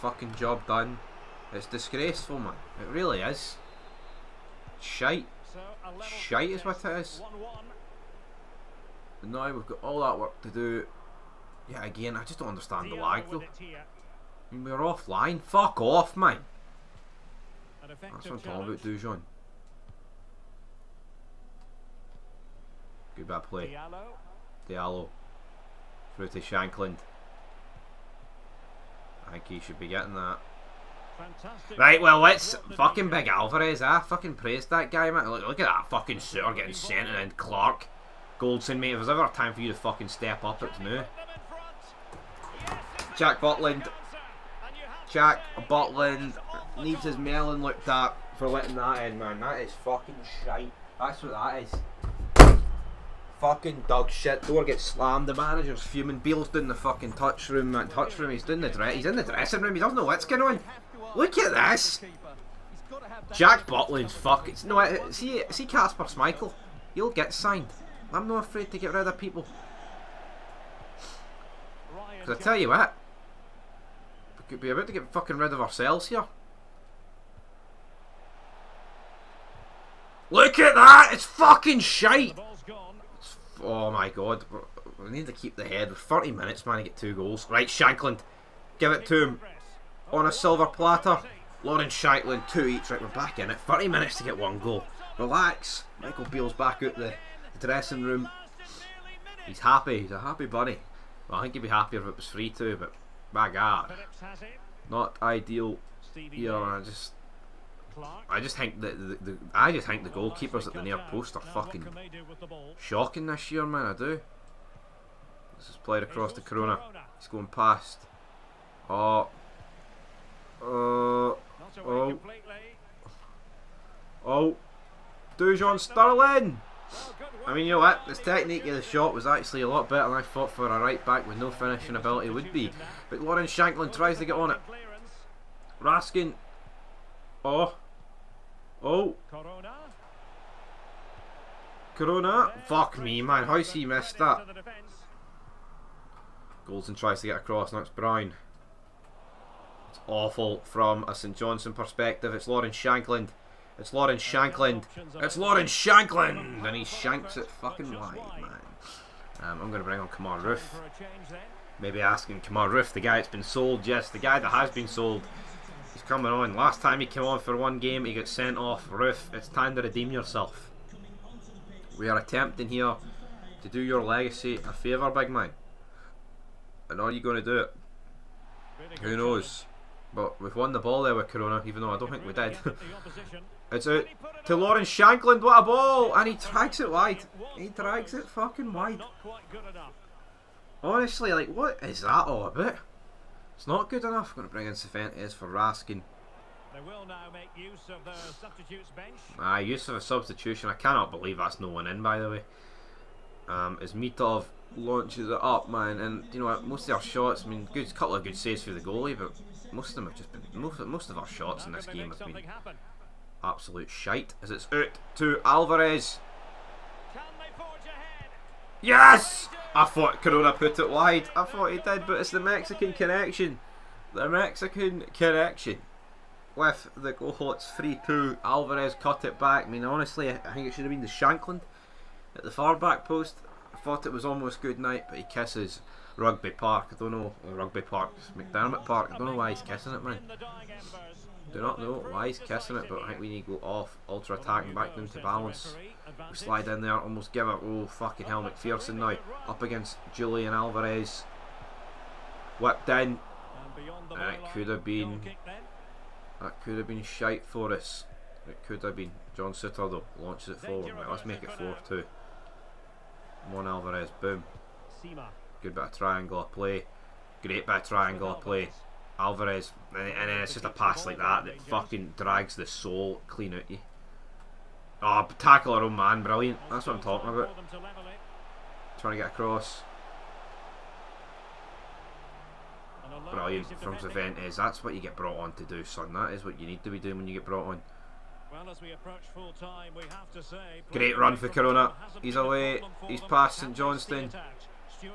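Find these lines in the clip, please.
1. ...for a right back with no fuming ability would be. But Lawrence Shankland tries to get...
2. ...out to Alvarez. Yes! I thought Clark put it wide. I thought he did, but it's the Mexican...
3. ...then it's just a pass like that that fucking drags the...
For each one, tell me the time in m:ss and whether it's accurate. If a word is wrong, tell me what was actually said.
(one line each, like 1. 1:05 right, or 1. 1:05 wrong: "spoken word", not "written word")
1. 2:10 wrong: "finishing", not "fuming"
2. 3:34 wrong: "Corona", not "Clark"
3. 4:30 right.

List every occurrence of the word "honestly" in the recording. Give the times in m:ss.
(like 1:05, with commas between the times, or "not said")
3:10, 3:49.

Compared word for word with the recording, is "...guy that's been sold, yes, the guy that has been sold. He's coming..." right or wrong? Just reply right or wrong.
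right.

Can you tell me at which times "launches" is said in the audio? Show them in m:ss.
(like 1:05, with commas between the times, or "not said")
3:24, 4:20.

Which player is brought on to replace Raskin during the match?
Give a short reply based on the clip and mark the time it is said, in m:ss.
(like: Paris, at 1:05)
Cifuentes, at 3:14.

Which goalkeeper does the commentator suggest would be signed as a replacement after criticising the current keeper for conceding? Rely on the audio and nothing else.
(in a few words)
Kasper Schmeichel.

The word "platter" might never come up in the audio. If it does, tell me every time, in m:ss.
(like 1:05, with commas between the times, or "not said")
1:30.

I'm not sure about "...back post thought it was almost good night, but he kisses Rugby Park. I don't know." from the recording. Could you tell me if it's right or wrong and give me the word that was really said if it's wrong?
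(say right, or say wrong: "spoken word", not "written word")
right.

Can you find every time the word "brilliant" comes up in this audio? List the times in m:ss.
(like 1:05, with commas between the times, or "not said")
4:36, 4:43.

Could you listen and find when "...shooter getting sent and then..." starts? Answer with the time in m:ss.
0:36.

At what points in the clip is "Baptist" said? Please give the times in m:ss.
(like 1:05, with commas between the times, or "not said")
not said.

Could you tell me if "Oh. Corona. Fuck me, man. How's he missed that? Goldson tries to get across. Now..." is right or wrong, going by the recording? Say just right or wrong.
right.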